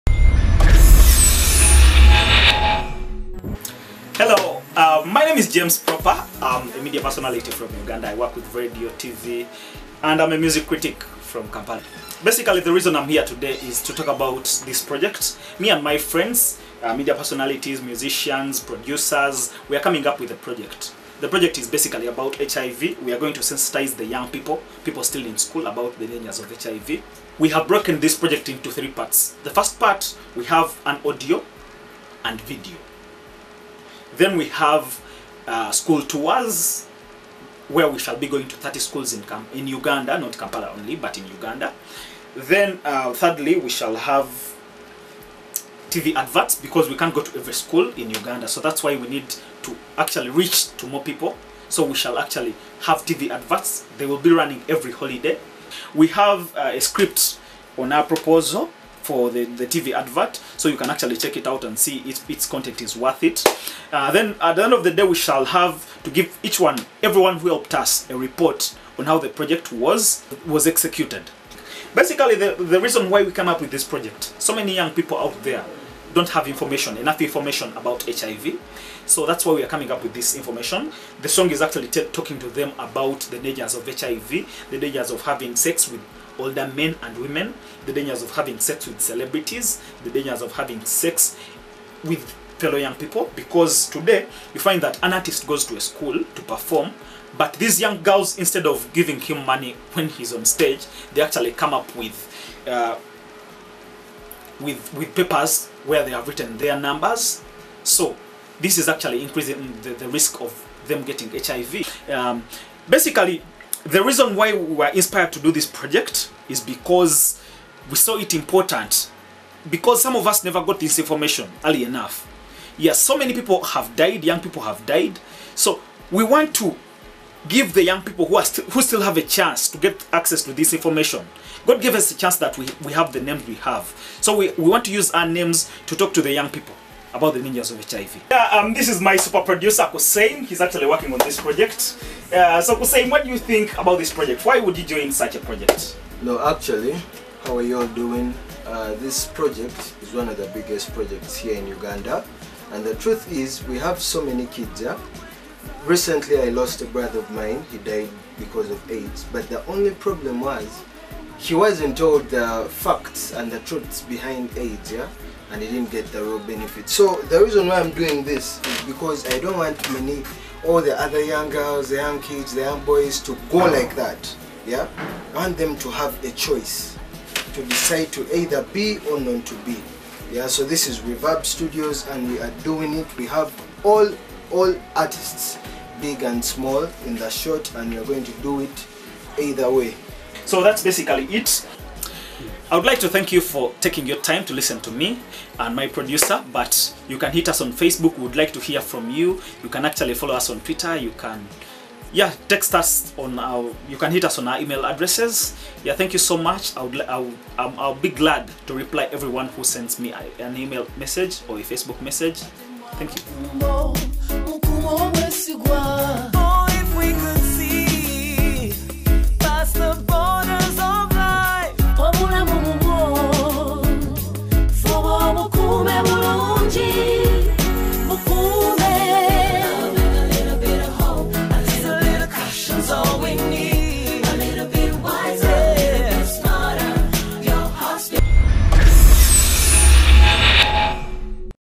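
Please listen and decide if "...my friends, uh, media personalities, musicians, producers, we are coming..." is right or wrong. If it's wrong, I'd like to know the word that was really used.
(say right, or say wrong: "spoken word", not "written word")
right.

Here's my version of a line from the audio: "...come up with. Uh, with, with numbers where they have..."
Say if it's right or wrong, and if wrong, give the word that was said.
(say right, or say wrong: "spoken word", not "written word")
wrong: "papers", not "numbers".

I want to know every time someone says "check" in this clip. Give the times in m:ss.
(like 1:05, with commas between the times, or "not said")
1:01.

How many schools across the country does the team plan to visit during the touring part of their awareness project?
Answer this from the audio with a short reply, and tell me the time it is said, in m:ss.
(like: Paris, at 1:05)
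30, at 0:38.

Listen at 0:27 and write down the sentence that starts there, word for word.
We have broken this project into three parts.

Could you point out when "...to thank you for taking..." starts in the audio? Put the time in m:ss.
3:12.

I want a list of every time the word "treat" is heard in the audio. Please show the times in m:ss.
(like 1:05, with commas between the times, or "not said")
not said.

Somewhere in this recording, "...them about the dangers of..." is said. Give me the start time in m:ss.
1:22.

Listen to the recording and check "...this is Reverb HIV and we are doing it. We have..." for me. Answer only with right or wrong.
wrong.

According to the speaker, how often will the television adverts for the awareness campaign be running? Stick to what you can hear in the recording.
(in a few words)
Every holiday.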